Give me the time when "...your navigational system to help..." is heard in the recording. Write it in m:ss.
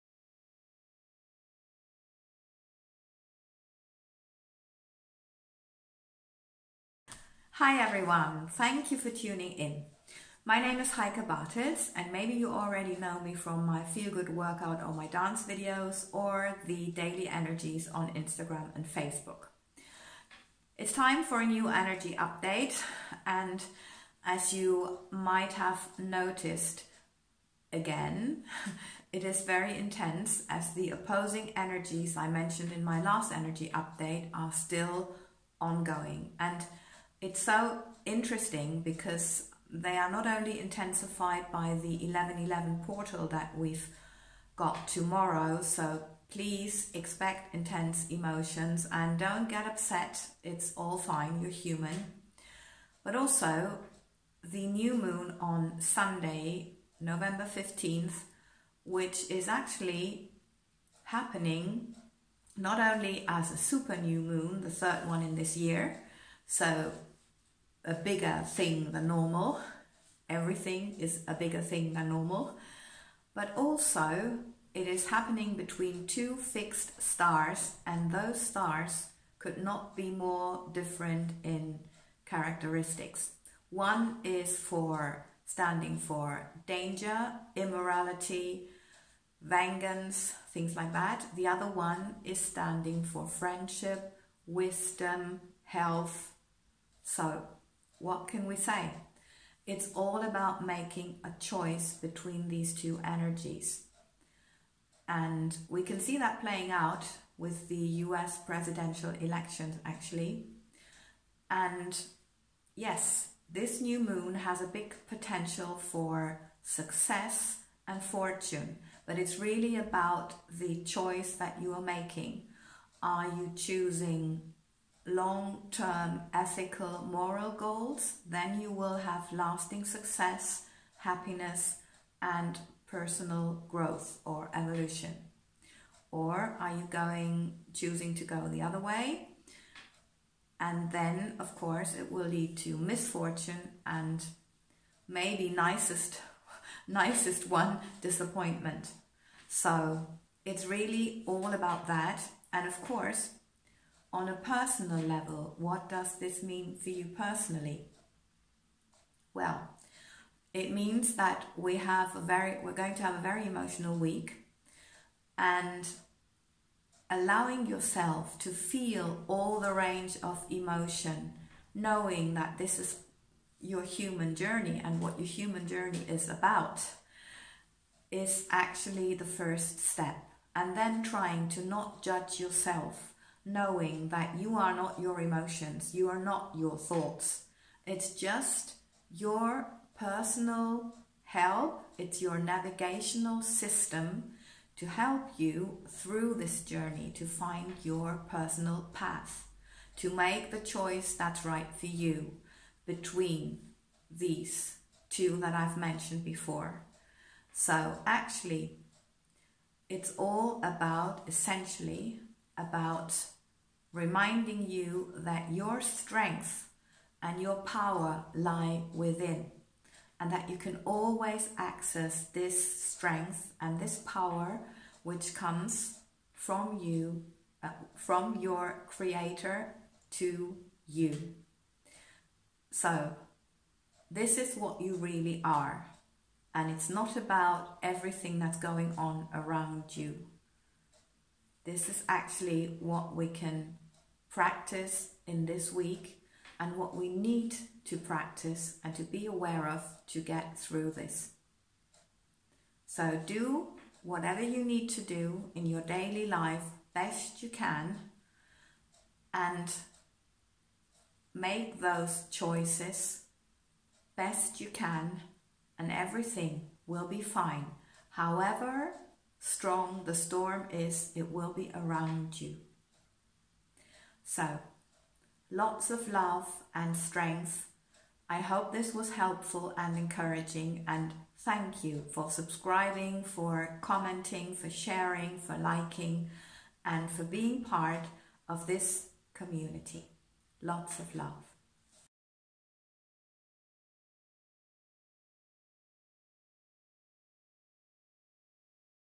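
3:12.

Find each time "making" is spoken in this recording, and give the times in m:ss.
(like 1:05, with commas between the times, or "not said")
1:40, 2:01.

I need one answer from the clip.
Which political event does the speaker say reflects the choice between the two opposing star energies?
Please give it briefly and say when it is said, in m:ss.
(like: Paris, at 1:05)
US presidential elections, at 1:48.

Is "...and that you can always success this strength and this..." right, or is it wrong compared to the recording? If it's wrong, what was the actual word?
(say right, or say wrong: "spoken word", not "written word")
wrong: "access", not "success".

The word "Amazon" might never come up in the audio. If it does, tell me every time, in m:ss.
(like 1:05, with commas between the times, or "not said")
not said.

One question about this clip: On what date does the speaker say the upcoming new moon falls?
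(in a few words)
November 15th.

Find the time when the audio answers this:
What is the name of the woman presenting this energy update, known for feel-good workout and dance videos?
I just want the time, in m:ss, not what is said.
0:10.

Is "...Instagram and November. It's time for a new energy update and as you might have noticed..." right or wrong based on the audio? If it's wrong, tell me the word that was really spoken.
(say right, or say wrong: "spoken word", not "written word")
wrong: "Facebook", not "November".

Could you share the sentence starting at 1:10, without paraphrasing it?
Everything is a bigger thing than normal.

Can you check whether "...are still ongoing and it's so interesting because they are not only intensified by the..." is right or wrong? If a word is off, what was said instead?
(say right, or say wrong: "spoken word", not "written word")
right.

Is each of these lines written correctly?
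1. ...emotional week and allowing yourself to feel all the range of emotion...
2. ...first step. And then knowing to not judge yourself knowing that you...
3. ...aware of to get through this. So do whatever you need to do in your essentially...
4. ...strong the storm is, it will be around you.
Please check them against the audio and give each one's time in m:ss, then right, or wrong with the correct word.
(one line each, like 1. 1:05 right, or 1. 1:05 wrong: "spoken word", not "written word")
1. 2:43 right
2. 2:59 wrong: "trying", not "knowing"
3. 4:09 wrong: "daily", not "essentially"
4. 4:29 right.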